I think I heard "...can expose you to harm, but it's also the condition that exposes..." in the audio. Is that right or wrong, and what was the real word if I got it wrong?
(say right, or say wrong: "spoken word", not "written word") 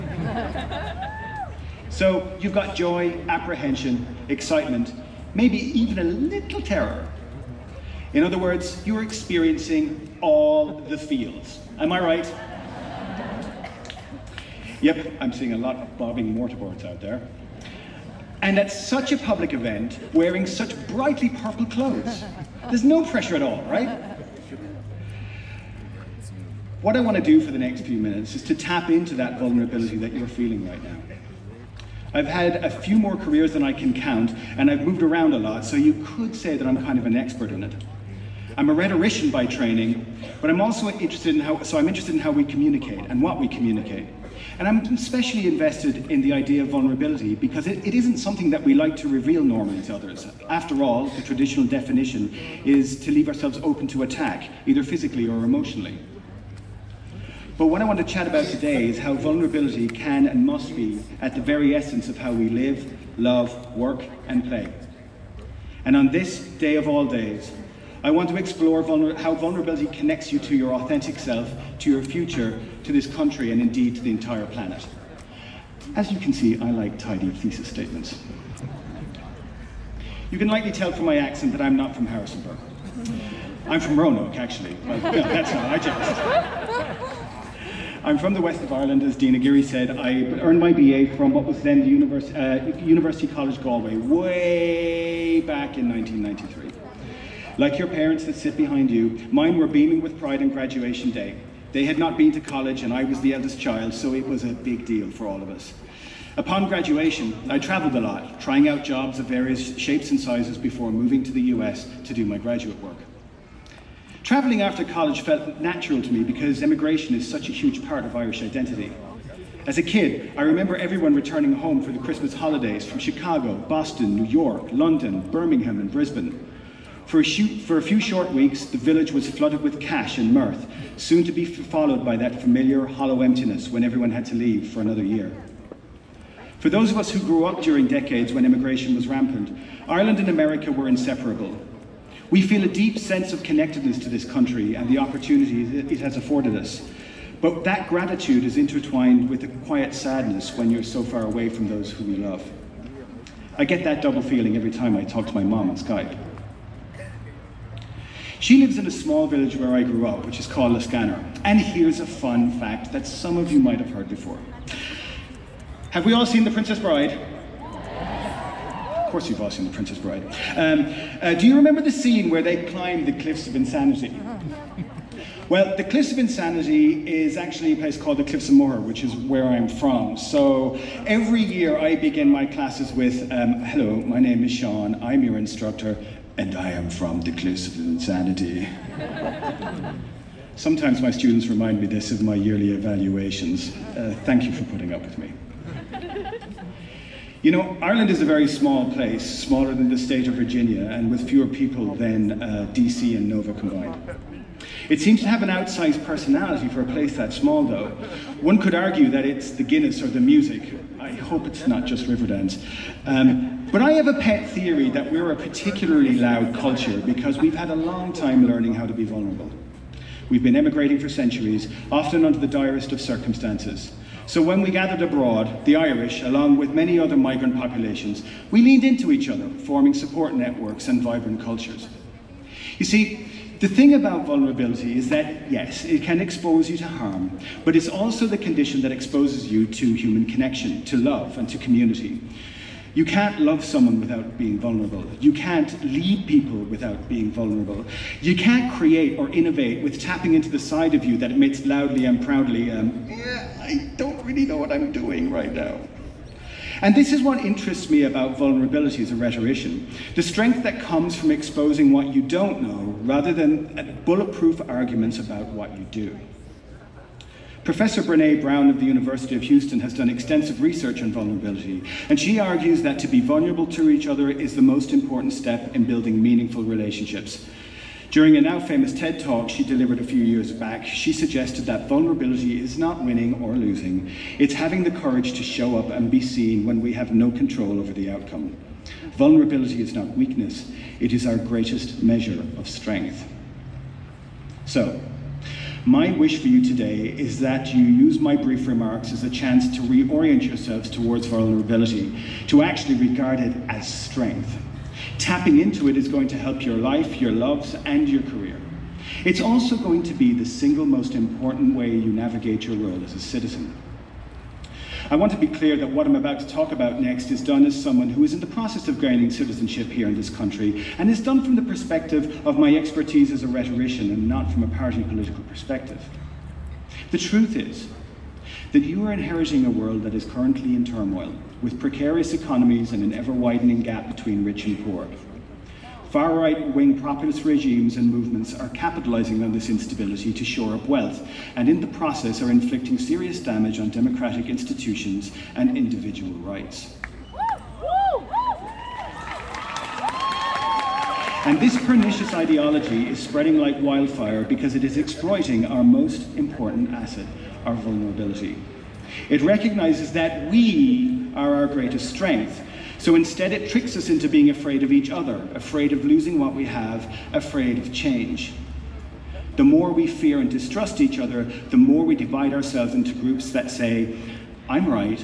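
right.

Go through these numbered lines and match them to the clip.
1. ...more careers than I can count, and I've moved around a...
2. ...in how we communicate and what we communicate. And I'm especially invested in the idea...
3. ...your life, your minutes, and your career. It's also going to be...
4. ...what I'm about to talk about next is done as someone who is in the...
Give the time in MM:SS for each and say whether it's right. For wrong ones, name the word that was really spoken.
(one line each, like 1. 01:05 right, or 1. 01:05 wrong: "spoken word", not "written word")
1. 00:32 right
2. 00:42 right
3. 05:06 wrong: "loves", not "minutes"
4. 05:15 right.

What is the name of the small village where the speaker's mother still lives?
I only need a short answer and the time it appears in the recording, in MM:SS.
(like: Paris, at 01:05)
Liscannor, at 02:40.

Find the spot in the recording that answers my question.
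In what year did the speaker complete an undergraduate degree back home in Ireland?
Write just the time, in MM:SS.
01:35.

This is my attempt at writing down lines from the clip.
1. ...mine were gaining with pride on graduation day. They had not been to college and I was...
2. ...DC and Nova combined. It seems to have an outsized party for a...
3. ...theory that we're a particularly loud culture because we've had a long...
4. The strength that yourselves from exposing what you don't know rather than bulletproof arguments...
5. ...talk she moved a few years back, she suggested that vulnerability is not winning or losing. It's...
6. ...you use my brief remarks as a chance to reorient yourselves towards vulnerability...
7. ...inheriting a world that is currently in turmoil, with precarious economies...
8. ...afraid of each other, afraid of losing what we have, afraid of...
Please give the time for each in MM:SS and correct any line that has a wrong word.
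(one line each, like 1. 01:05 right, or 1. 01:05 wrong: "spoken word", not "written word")
1. 01:39 wrong: "beaming", not "gaining"
2. 03:22 wrong: "personality", not "party"
3. 03:34 right
4. 04:20 wrong: "comes", not "yourselves"
5. 04:39 wrong: "delivered", not "moved"
6. 04:57 right
7. 05:29 right
8. 06:04 right.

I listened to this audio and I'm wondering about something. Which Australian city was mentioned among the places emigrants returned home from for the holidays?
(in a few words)
Brisbane.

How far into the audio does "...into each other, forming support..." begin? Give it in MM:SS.
03:48.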